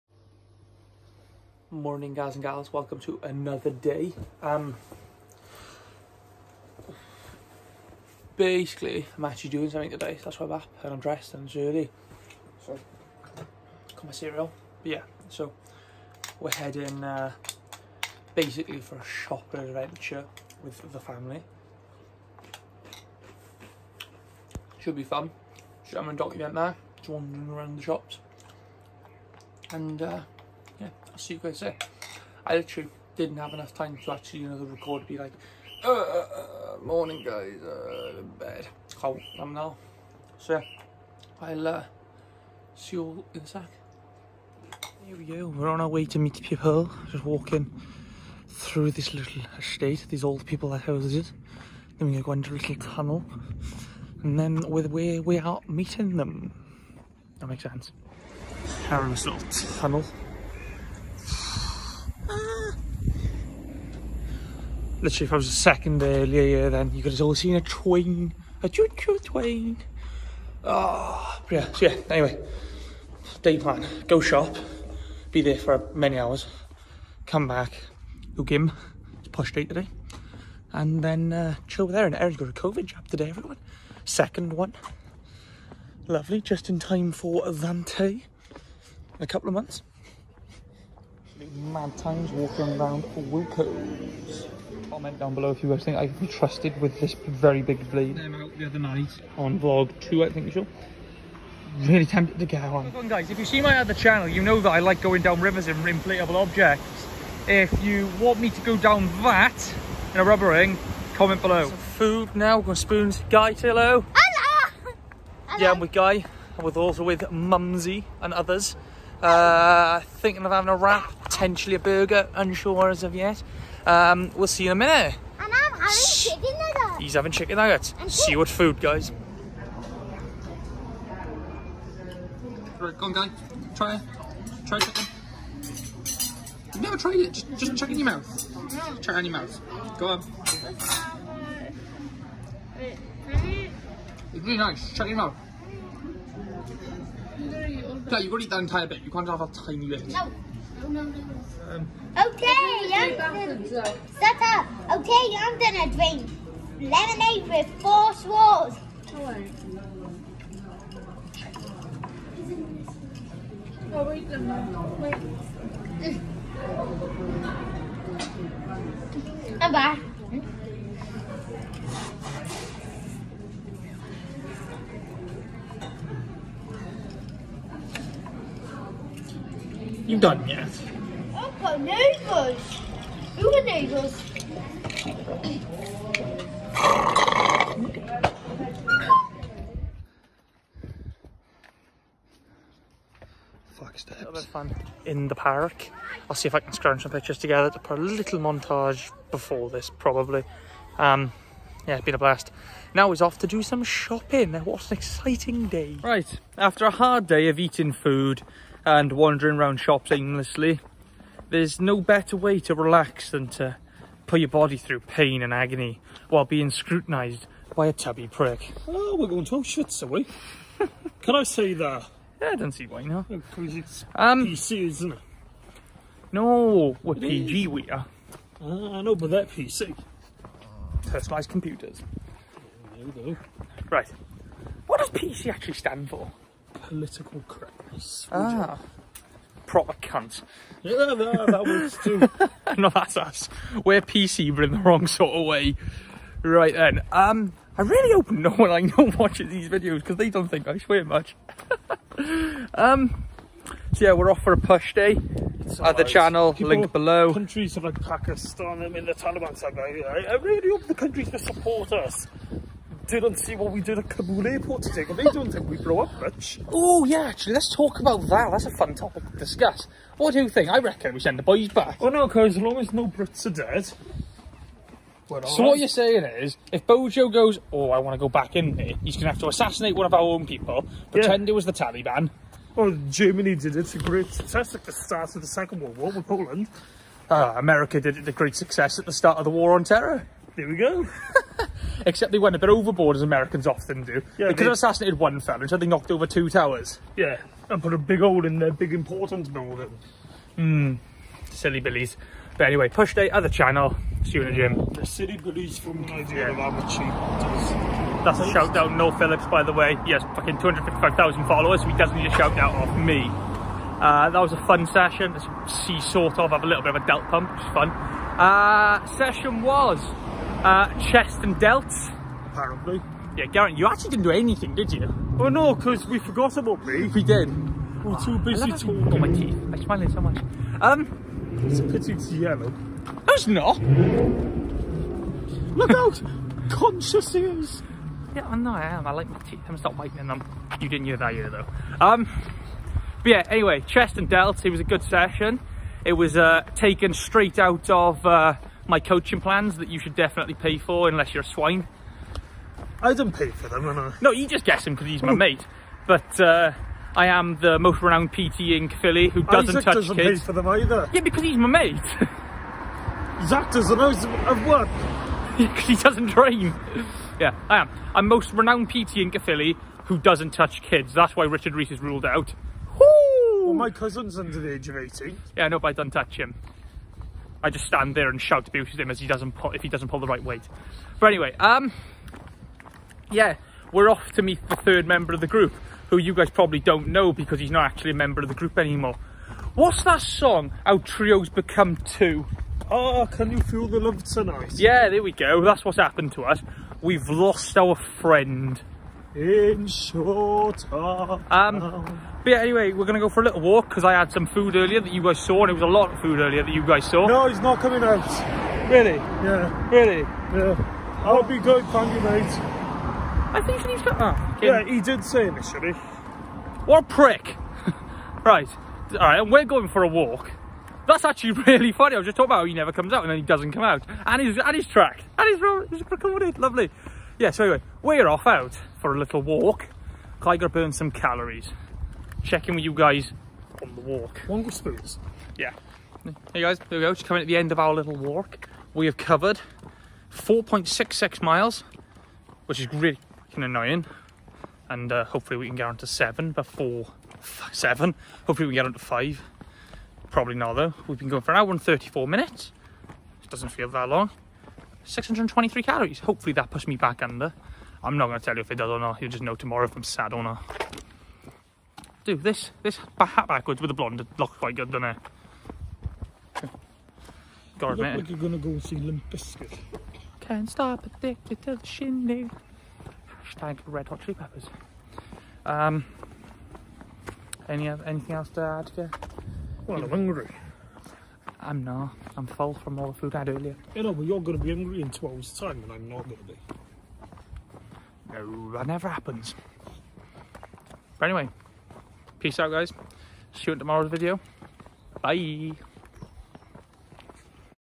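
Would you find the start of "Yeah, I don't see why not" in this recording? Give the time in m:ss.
3:42.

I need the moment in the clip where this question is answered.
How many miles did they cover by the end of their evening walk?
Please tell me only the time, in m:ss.
7:20.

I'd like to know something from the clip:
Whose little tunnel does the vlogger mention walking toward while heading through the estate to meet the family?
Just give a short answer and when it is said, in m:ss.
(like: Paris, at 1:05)
Harrow's, at 0:58.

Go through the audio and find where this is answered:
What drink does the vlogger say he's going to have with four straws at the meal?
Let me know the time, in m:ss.
2:36.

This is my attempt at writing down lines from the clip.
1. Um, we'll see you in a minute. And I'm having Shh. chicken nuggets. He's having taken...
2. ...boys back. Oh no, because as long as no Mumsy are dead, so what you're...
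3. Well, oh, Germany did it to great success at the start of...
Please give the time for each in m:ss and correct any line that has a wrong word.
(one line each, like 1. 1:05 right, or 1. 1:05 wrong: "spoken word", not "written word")
1. 2:03 wrong: "chicken", not "taken"
2. 4:31 wrong: "Brits", not "Mumsy"
3. 4:42 right.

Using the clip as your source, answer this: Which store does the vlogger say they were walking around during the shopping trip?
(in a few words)
Wilko's.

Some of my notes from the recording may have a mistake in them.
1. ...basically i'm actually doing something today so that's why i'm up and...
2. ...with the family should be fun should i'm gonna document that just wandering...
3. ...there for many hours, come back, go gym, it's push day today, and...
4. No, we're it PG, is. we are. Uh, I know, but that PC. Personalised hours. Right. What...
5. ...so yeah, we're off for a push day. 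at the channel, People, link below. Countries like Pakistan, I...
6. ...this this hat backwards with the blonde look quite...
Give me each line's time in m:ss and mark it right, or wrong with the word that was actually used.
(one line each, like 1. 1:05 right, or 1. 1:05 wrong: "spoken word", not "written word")
1. 0:08 right
2. 0:20 right
3. 1:15 right
4. 3:46 wrong: "computers", not "hours"
5. 4:13 right
6. 7:42 right.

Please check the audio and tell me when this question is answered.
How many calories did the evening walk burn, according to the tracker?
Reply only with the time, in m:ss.
7:35.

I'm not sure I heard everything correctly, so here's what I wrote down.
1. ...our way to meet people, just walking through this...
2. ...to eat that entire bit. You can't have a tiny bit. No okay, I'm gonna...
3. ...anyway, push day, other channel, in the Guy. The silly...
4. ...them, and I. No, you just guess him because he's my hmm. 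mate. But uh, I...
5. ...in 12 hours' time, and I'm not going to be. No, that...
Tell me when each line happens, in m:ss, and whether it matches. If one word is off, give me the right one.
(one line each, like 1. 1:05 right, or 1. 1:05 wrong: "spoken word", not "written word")
1. 0:45 right
2. 2:28 right
3. 5:02 wrong: "Gym", not "Guy"
4. 5:53 right
5. 8:05 right.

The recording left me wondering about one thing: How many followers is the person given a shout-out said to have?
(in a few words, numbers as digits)
255,000.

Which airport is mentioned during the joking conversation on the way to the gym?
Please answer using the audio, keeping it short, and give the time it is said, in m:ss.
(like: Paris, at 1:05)
Kabul airport, at 4:24.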